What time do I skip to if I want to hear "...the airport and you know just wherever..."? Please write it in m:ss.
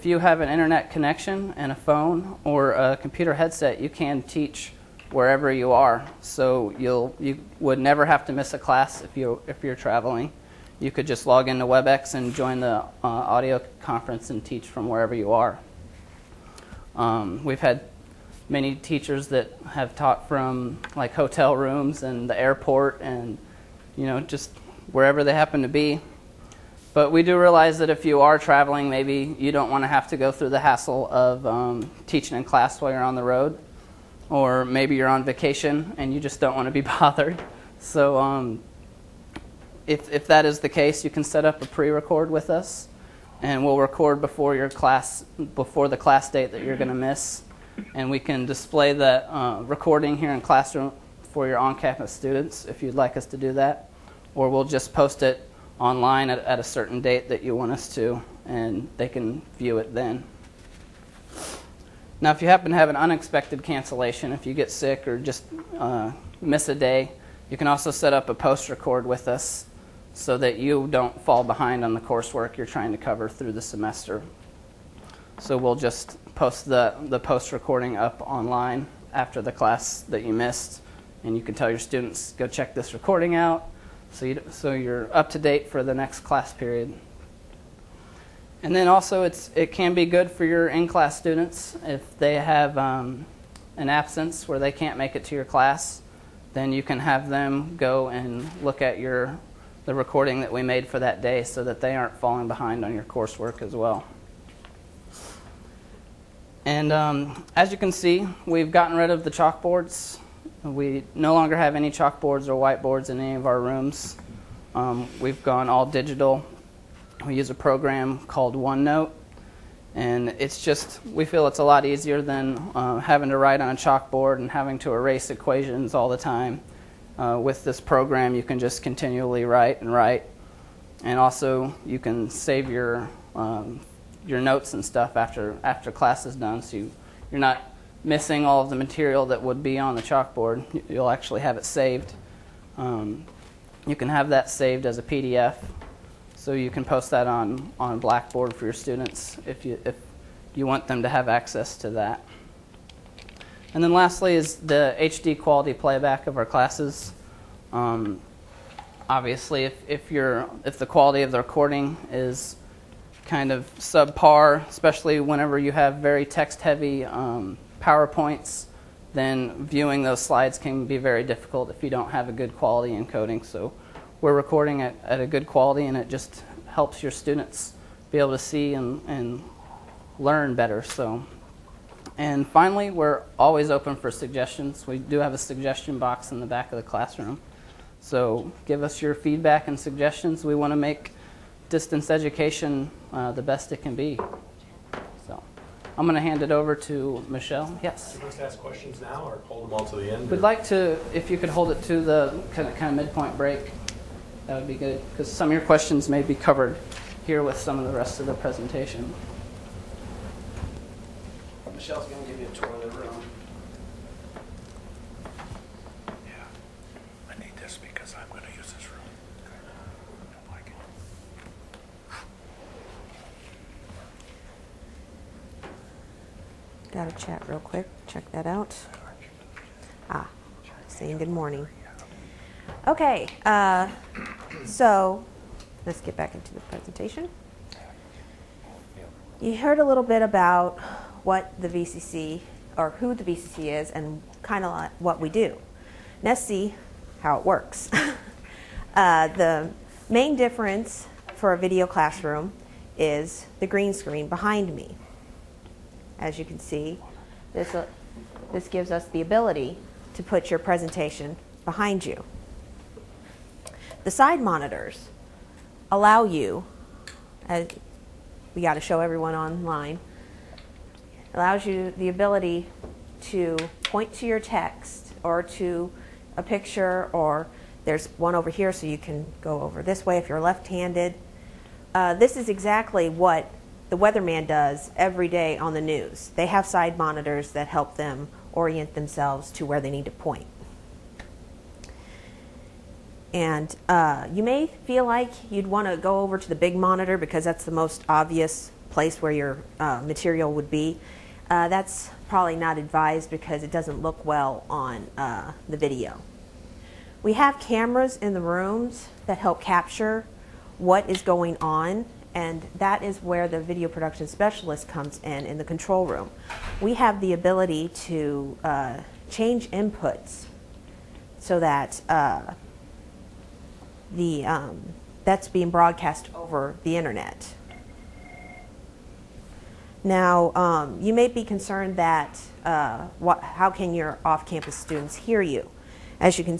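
0:22.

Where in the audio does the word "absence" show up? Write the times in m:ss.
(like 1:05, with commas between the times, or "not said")
1:33.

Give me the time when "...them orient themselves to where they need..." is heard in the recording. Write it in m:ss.
4:47.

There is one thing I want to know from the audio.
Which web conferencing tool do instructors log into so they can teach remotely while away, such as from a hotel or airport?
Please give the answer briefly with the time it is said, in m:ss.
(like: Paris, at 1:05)
WebEx, at 0:11.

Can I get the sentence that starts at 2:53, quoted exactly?
So we're recording it at a good quality and it just helps your students be able to see and, and learn better.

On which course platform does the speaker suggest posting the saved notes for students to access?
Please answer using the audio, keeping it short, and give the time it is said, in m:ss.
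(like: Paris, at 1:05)
Blackboard, at 2:27.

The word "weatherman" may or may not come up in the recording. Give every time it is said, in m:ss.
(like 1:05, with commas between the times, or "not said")
4:43.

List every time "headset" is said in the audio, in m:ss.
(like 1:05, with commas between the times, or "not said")
0:03.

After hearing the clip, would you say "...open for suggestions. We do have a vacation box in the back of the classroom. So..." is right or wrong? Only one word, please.
wrong.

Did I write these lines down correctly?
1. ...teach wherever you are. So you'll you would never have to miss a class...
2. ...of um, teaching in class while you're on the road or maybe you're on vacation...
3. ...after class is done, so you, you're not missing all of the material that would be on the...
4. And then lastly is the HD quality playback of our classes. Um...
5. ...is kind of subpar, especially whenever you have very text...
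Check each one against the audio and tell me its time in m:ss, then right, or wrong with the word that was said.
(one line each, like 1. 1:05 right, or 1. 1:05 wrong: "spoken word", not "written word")
1. 0:04 right
2. 0:31 right
3. 2:15 right
4. 2:33 right
5. 2:42 right.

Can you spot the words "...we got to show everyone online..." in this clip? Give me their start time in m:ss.
4:28.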